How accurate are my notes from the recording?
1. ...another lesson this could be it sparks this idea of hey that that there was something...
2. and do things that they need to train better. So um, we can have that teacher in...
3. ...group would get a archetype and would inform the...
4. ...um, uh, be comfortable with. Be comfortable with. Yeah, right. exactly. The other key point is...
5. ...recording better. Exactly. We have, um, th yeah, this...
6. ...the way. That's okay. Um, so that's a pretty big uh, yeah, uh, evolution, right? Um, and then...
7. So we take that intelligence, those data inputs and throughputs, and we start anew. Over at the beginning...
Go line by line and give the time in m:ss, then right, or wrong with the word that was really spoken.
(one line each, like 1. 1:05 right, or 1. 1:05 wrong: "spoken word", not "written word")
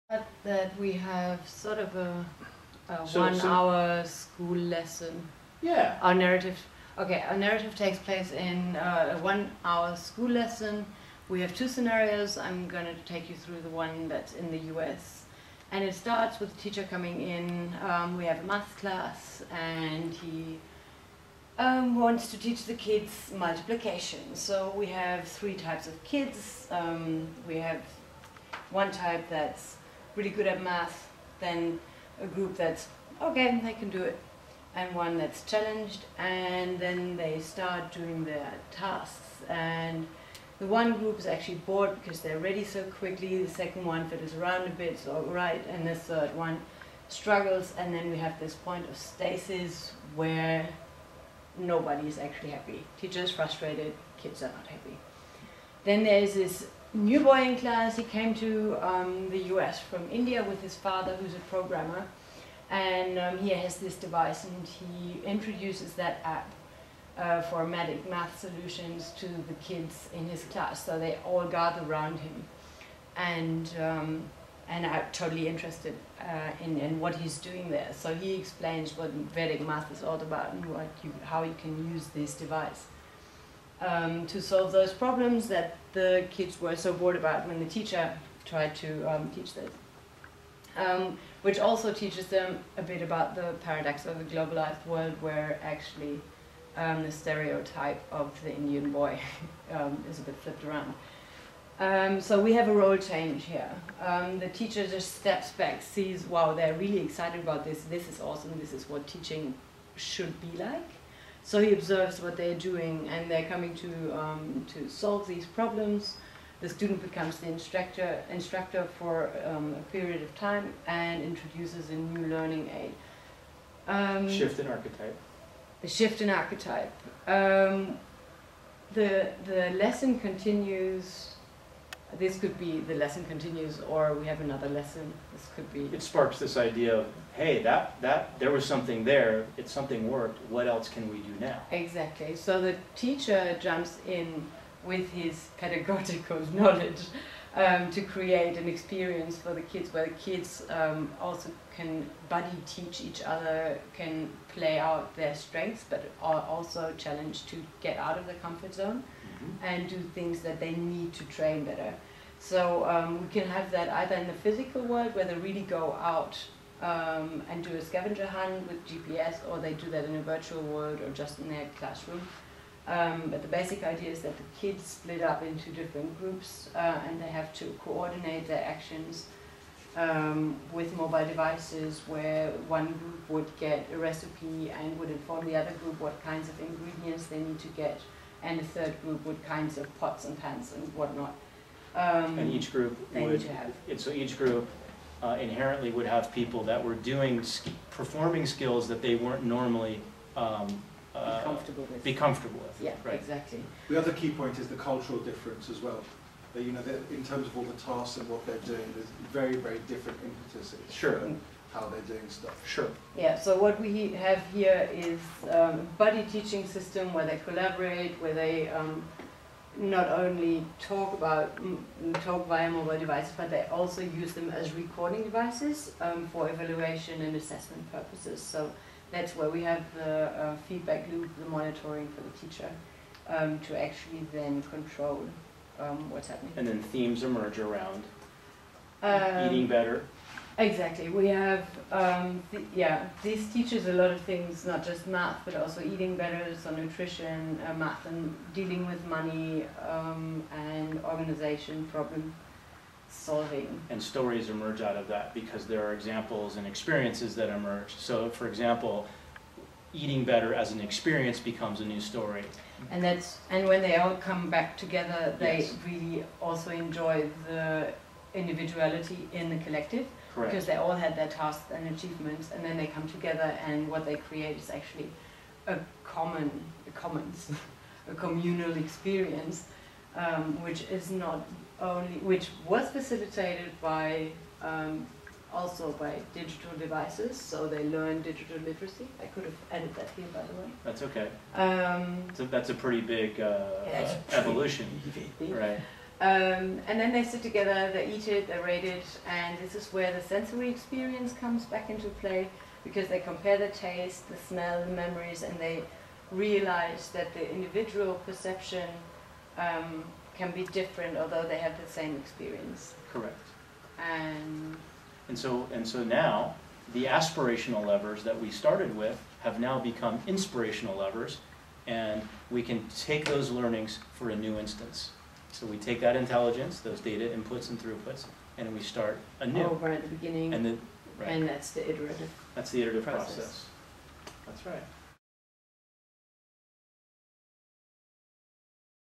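1. 2:14 right
2. 2:39 wrong: "either", not "teacher"
3. 3:02 wrong: "recipe", not "archetype"
4. 3:20 right
5. 3:59 wrong: "eating", not "recording"
6. 4:50 right
7. 5:25 right.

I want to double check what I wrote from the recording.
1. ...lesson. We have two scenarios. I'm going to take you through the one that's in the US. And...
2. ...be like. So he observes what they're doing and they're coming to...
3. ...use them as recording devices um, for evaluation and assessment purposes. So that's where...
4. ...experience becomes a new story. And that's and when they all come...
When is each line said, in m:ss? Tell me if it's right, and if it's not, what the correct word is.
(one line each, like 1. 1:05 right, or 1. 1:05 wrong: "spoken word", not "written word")
1. 0:10 right
2. 1:50 right
3. 3:44 right
4. 4:20 right.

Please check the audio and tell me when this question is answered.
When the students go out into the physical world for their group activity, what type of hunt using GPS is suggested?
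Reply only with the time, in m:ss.
2:47.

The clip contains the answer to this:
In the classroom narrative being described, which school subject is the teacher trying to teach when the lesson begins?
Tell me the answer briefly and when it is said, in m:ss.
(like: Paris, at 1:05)
Multiplication, at 0:23.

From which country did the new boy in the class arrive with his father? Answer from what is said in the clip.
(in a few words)
India.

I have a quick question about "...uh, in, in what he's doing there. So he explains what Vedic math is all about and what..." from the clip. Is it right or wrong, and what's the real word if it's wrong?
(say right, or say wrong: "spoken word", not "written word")
right.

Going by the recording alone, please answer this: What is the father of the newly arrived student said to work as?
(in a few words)
A programmer.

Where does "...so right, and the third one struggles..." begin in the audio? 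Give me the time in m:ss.
0:44.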